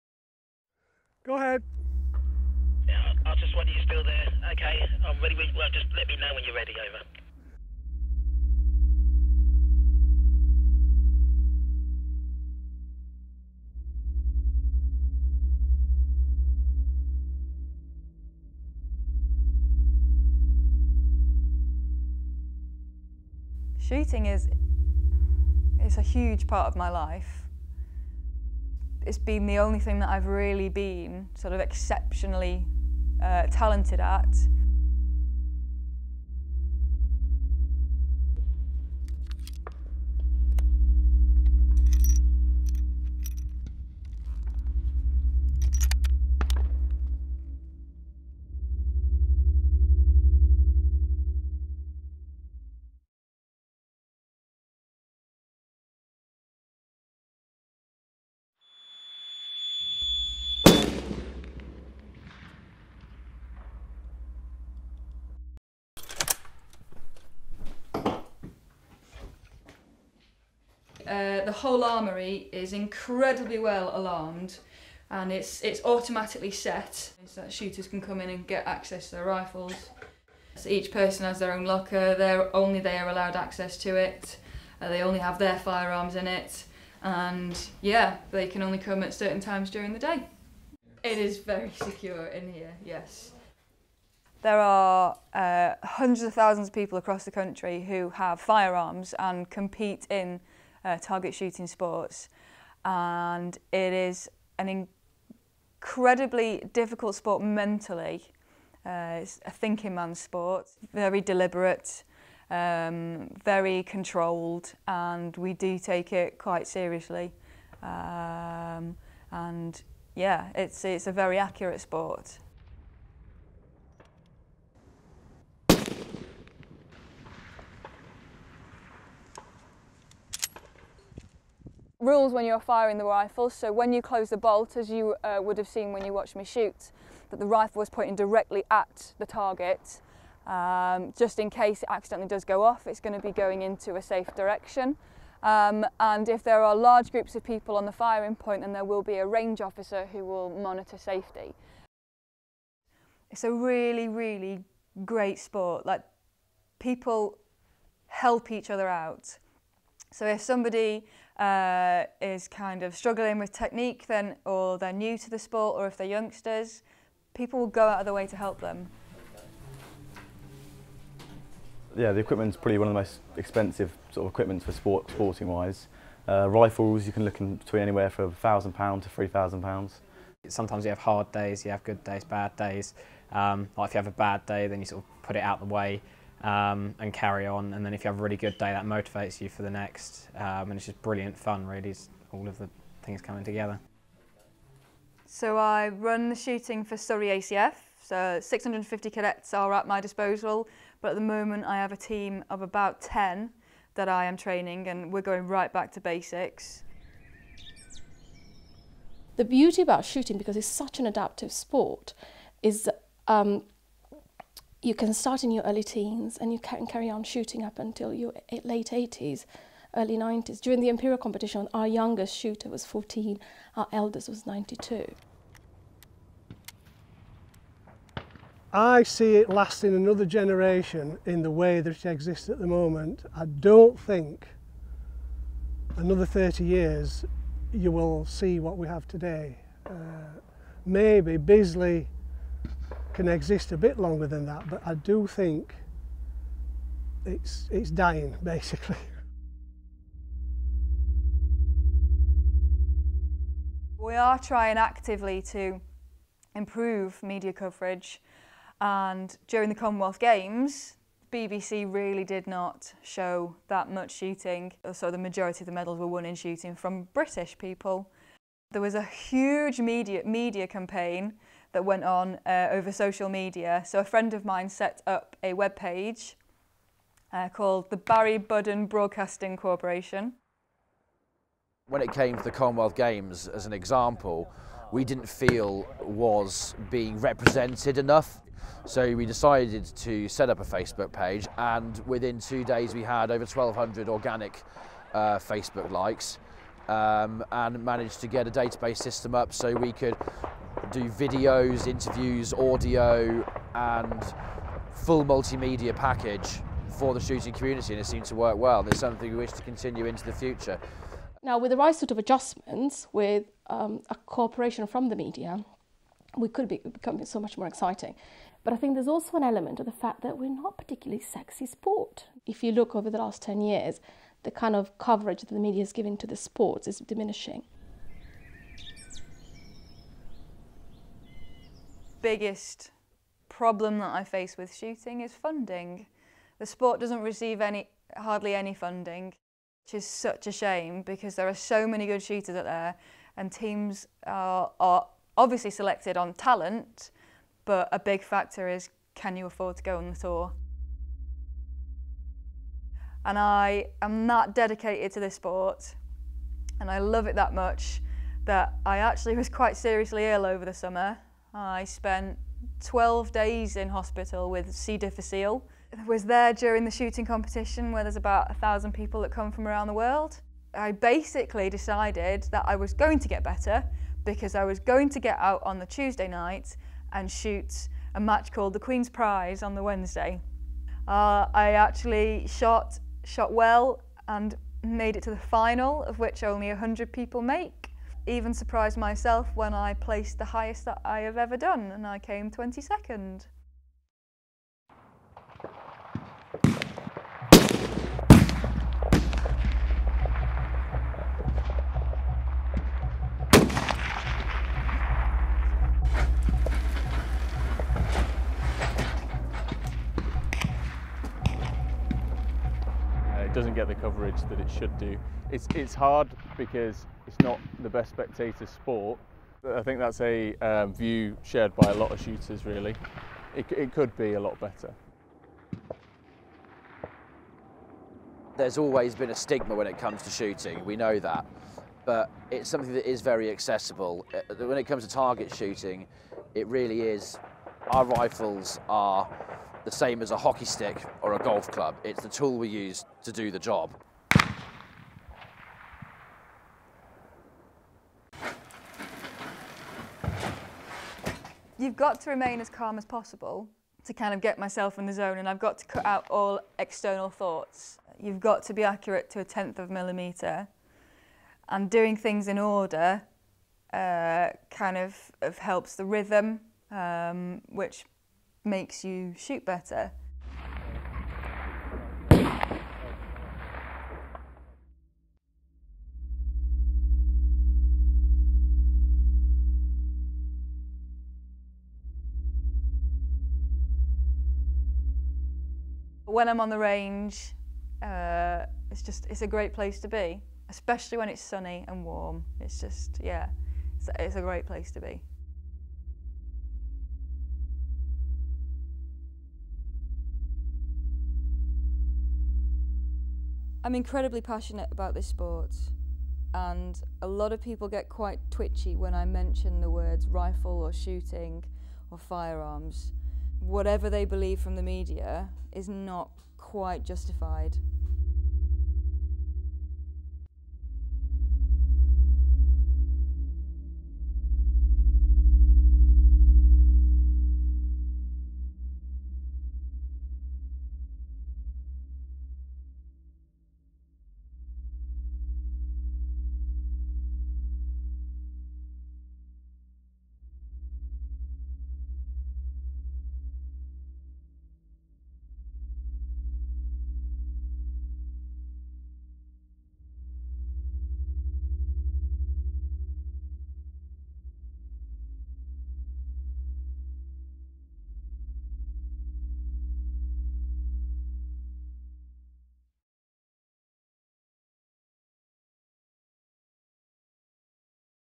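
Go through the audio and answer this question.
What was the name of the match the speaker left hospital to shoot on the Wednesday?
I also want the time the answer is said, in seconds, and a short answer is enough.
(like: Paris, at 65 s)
Queen's Prize, at 378 s.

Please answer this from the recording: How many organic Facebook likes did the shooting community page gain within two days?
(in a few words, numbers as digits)
1,200.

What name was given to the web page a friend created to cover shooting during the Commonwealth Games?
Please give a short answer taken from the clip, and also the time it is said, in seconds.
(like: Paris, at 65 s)
Barry Budden Broadcasting Corporation, at 277 s.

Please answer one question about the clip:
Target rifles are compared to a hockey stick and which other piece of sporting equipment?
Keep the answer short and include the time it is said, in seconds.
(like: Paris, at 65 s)
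golf club, at 441 s.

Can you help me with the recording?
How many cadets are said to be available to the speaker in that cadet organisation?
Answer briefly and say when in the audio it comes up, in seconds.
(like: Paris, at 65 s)
650, at 198 s.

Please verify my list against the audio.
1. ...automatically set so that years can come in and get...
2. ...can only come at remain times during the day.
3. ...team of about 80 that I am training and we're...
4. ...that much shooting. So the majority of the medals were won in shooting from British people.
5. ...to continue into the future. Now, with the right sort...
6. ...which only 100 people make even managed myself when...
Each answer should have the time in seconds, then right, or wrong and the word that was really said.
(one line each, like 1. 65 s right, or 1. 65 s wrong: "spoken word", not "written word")
1. 75 s wrong: "shooters", not "years"
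2. 88 s wrong: "certain", not "remain"
3. 201 s wrong: "10", not "80"
4. 263 s right
5. 309 s right
6. 386 s wrong: "surprised", not "managed".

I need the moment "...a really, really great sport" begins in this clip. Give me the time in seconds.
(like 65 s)
153 s.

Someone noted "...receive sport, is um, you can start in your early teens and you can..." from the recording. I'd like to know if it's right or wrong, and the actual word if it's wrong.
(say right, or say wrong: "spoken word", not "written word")
wrong: "adaptive", not "receive".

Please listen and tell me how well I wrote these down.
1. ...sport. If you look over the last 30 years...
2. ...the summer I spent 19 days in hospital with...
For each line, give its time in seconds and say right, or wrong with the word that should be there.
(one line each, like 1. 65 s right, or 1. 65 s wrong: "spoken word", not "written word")
1. 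321 s wrong: "10", not "30"
2. 360 s wrong: "12", not "19".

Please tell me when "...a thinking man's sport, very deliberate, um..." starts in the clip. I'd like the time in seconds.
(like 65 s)
109 s.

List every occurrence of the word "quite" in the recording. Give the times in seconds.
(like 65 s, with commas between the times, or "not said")
116 s, 359 s, 508 s, 516 s.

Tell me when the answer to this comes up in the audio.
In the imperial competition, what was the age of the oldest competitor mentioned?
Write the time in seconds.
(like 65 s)
224 s.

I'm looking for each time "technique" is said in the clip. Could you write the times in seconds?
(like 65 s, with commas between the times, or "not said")
163 s.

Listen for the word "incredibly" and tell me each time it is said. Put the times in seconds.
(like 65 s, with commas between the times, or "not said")
72 s, 105 s, 503 s.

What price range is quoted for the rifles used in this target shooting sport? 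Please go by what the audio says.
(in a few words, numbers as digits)
£1,000 to £3,000.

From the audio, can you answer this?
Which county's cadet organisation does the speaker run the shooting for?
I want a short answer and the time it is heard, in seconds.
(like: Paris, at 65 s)
Surrey ACF, at 196 s.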